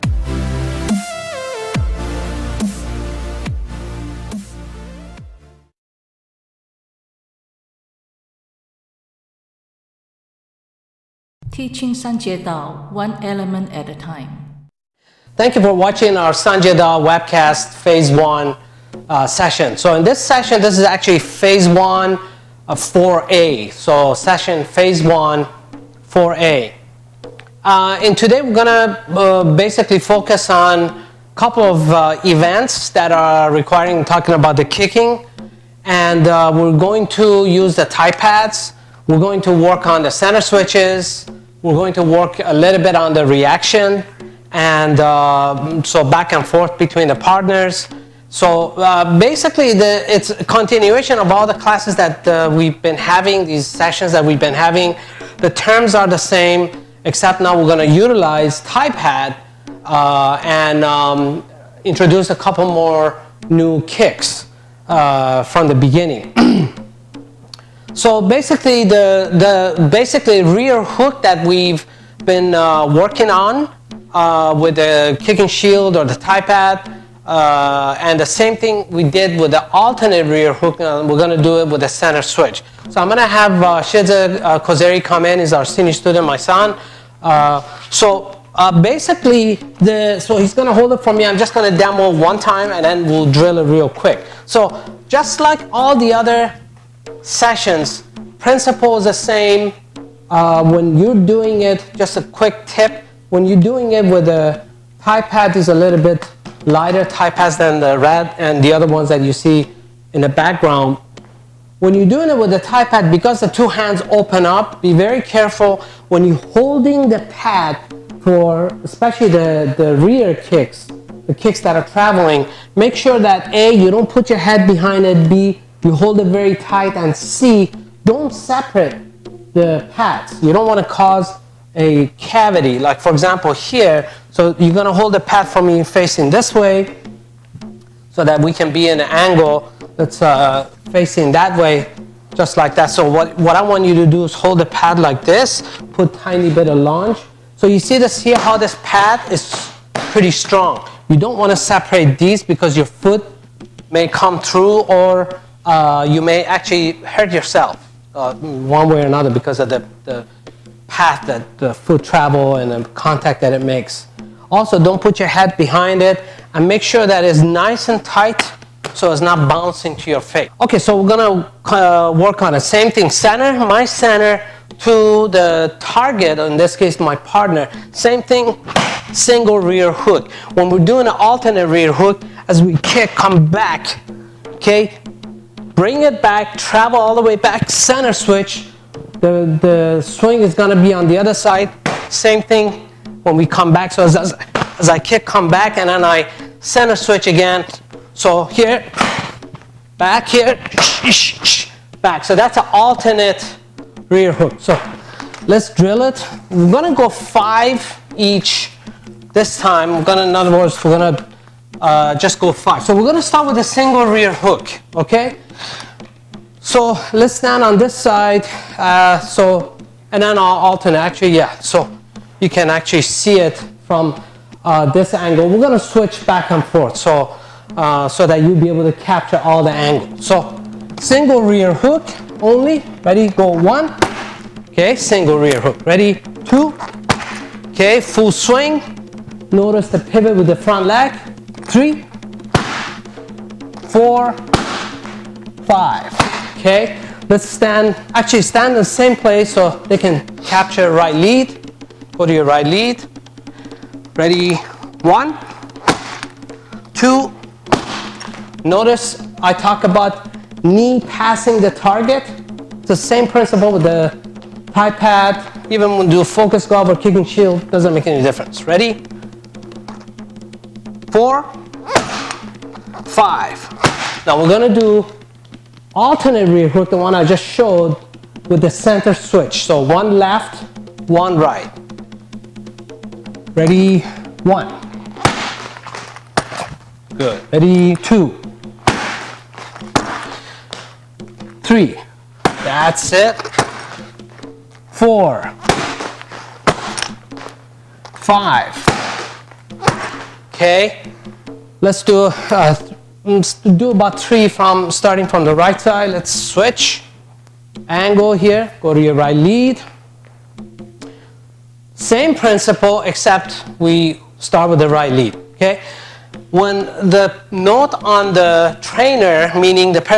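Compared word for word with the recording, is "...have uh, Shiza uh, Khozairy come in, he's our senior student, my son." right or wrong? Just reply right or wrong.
right.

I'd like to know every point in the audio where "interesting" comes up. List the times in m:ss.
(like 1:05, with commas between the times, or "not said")
not said.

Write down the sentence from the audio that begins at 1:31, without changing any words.
I'm just going to demo one time, and then we'll drill it real quick.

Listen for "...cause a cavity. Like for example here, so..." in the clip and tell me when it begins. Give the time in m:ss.
2:10.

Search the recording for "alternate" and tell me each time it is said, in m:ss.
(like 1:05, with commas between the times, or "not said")
1:19, 3:01, 3:22, 3:40, 4:35.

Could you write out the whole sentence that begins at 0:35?
And uh, we're going to use the Thai pads.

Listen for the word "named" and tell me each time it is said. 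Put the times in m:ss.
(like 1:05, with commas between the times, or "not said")
not said.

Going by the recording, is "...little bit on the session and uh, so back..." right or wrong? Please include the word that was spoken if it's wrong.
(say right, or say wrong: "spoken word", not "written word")
wrong: "reaction", not "session".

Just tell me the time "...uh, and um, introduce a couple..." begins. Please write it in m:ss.
0:59.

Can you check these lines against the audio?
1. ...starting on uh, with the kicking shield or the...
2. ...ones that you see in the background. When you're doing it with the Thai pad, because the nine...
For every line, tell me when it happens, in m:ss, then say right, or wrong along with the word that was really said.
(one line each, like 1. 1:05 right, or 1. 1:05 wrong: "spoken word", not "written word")
1. 1:12 wrong: "working", not "starting"
2. 1:48 wrong: "two", not "nine".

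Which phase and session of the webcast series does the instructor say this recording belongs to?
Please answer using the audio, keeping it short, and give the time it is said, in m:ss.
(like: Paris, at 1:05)
Phase one, 4A, at 0:24.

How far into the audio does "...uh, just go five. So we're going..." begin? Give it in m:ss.
3:31.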